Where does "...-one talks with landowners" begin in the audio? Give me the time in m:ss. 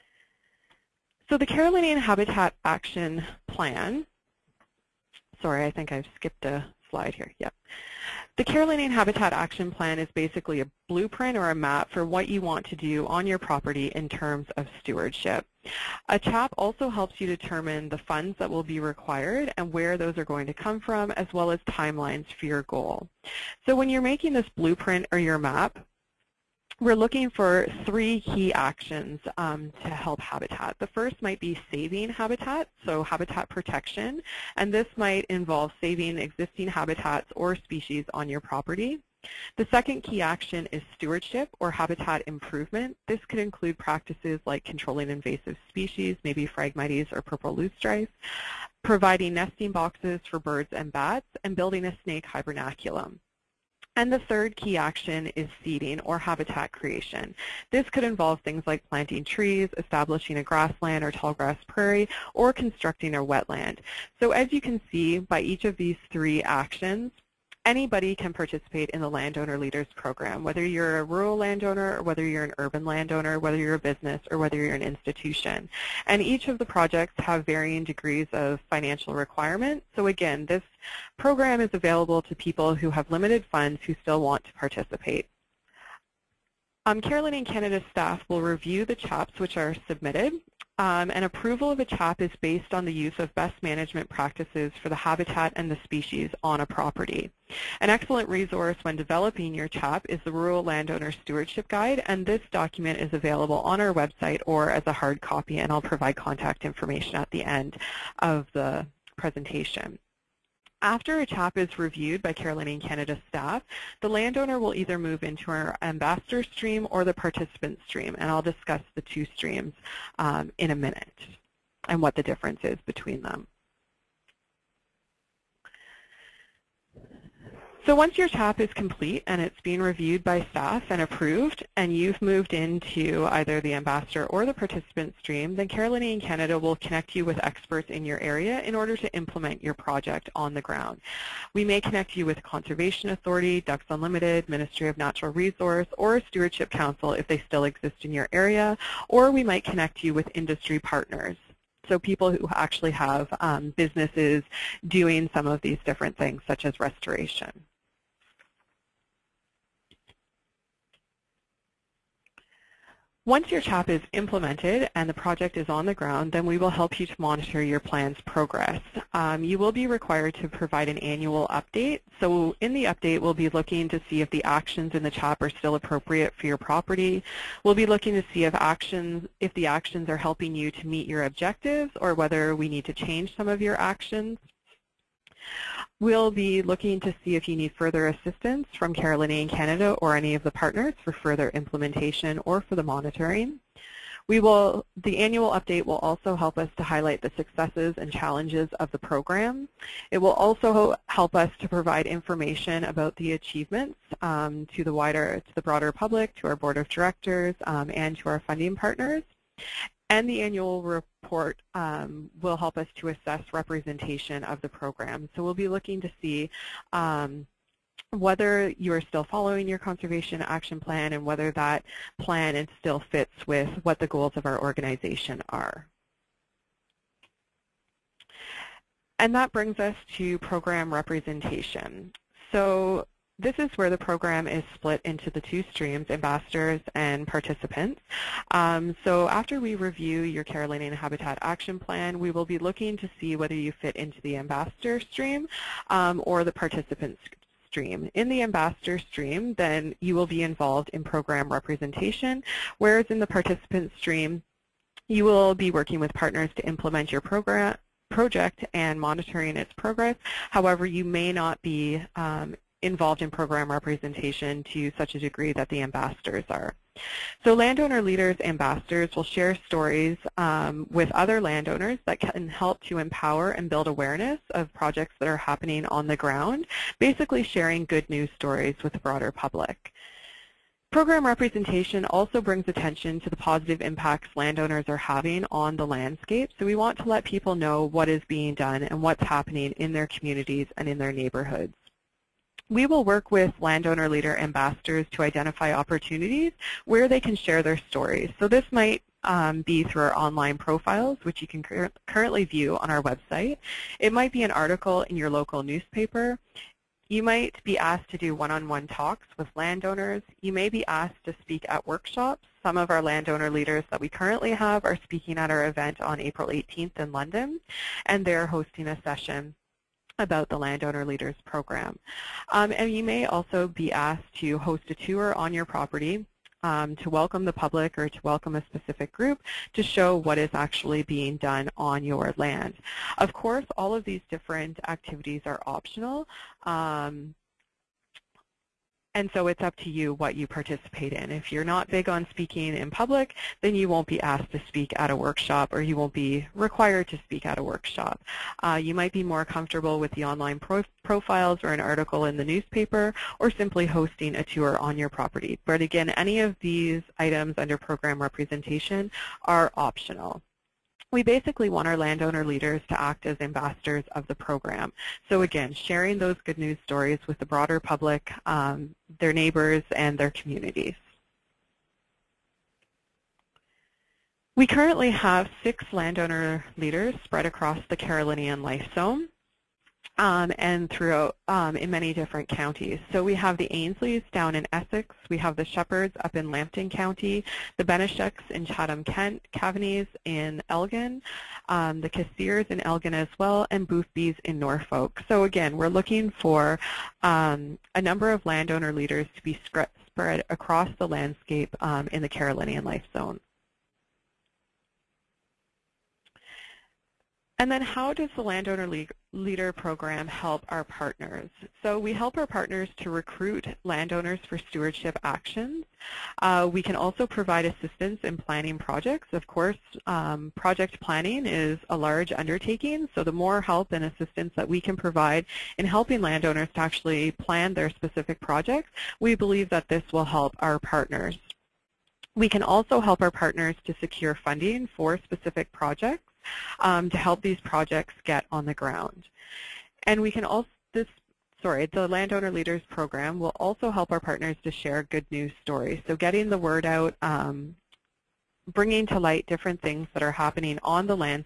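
5:08.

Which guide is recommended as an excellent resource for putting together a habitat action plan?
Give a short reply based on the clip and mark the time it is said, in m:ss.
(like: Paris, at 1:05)
Rural Landowner Stewardship Guide, at 1:40.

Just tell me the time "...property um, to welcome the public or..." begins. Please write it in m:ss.
5:25.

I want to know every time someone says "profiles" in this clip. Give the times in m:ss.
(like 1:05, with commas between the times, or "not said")
5:00, 5:51.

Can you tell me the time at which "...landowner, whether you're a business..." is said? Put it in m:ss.
1:12.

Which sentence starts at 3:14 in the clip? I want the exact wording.
We will, the annual update will also help us to highlight the successes and challenges of the program.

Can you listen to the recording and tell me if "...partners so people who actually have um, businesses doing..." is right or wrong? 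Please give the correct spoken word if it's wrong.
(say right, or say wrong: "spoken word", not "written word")
right.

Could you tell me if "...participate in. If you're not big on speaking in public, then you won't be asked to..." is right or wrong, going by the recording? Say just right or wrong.
right.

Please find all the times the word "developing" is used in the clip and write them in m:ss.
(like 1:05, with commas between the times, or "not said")
1:38.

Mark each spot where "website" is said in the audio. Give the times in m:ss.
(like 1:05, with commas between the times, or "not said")
1:43, 5:03.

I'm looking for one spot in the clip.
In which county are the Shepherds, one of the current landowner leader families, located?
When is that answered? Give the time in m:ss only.
6:26.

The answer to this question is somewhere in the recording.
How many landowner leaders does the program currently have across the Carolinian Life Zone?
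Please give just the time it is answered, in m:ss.
6:15.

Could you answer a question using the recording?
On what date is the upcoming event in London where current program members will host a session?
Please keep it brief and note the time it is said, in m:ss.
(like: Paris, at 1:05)
April 18th, at 5:16.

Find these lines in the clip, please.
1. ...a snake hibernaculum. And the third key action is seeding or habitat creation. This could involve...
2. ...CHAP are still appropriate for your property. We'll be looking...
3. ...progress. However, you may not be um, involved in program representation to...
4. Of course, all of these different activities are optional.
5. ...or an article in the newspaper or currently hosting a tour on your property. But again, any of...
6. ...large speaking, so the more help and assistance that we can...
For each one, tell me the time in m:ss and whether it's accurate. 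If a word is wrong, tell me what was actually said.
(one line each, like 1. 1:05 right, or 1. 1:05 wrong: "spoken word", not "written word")
1. 0:51 right
2. 2:55 right
3. 4:19 right
4. 5:33 right
5. 5:51 wrong: "simply", not "currently"
6. 7:01 wrong: "undertaking", not "speaking".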